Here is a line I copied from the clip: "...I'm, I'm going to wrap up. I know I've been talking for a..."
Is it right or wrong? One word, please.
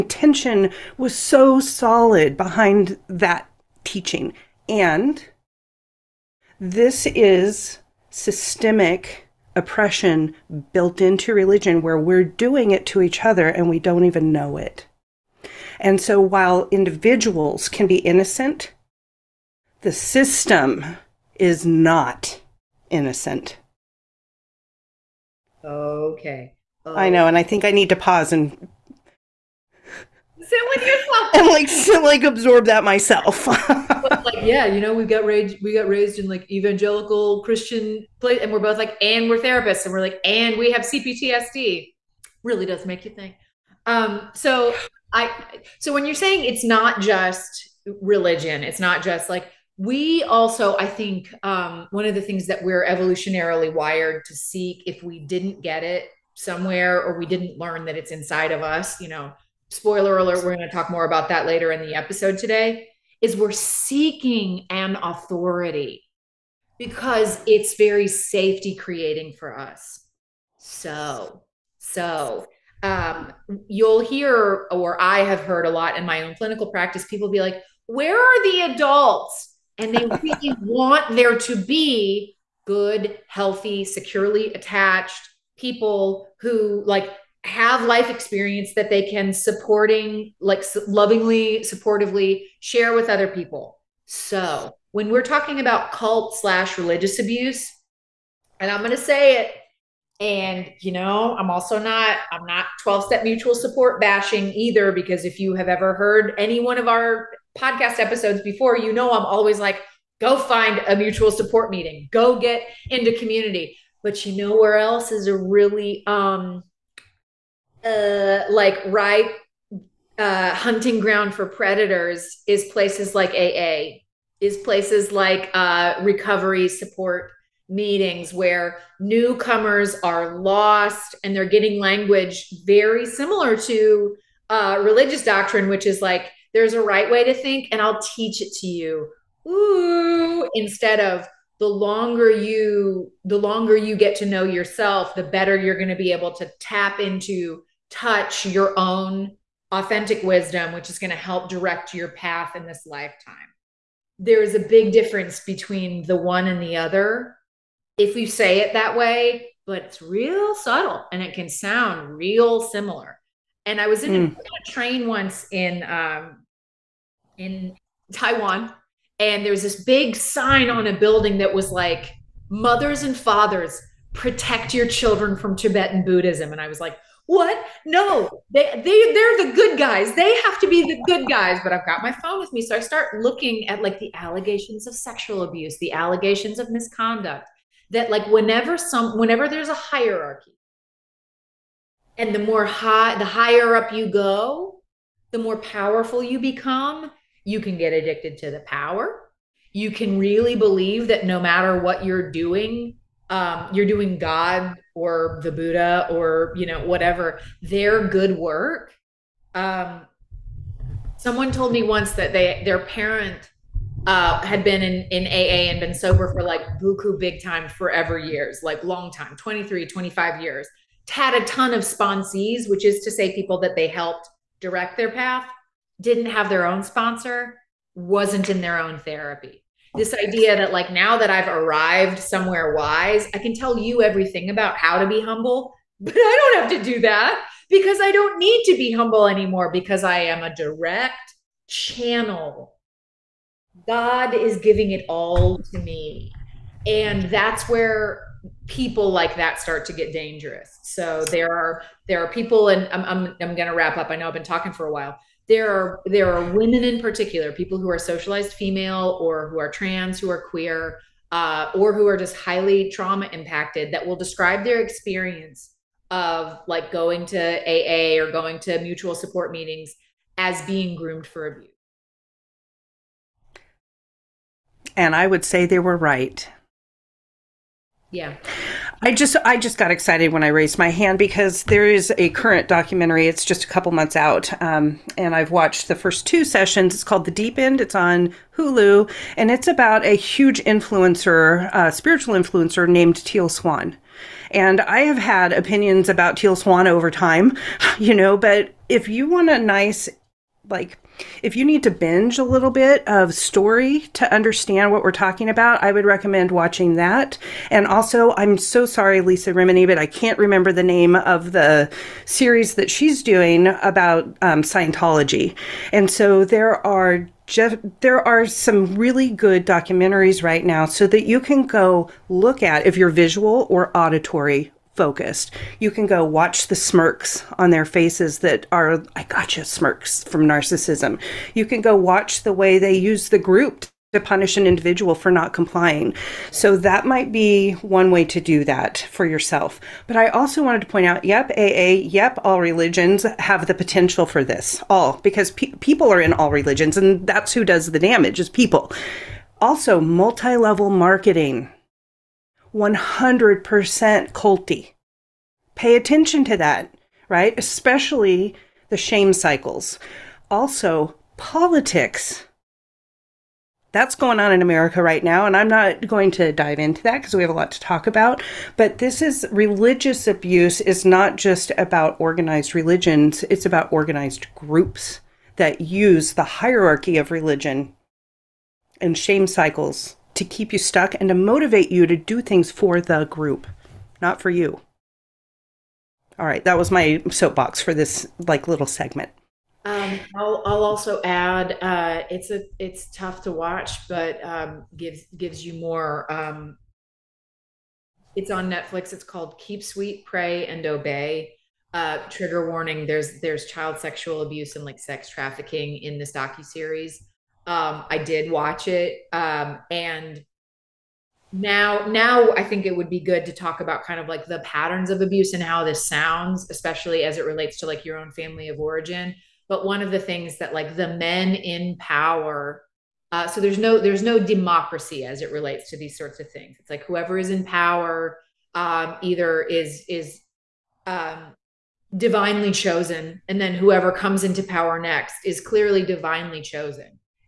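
right.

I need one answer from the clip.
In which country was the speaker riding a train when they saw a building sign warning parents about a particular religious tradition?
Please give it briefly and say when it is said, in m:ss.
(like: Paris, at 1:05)
Taiwan, at 2:48.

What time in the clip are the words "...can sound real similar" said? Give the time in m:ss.
2:41.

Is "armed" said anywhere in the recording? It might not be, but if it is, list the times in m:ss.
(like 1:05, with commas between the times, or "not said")
not said.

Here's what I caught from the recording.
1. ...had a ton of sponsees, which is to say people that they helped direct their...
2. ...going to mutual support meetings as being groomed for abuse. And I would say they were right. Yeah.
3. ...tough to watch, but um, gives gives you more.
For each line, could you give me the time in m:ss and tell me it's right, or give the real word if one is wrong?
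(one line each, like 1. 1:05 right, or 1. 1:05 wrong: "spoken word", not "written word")
1. 3:41 right
2. 4:28 right
3. 6:33 right.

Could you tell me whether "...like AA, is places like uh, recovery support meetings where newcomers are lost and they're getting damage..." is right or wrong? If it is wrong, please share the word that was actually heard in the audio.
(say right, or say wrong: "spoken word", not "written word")
wrong: "language", not "damage".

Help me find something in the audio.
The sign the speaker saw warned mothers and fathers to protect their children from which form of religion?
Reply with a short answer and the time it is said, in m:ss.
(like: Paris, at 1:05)
Tibetan Buddhism, at 2:55.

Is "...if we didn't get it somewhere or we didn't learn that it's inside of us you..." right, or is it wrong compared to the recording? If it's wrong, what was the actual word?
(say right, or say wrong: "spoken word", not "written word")
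right.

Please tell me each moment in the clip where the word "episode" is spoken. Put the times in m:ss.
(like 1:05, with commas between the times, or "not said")
1:01, 1:47.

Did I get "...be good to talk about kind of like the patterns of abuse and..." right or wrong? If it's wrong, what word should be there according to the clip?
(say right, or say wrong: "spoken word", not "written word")
right.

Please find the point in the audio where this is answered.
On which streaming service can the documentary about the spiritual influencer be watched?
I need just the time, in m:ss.
4:48.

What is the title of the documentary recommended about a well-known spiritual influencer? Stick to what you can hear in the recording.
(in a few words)
The Deep End.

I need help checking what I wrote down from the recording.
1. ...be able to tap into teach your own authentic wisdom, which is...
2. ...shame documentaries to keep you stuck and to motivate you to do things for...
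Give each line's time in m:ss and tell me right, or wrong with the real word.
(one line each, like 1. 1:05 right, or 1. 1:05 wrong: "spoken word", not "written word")
1. 2:25 wrong: "touch", not "teach"
2. 6:19 wrong: "cycles", not "documentaries".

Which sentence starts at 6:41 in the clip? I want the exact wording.
Uh, trigger warning: there's there's child sexual abuse and like sex trafficking in this docu series.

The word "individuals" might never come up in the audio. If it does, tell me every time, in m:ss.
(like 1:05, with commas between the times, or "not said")
0:16, 5:34.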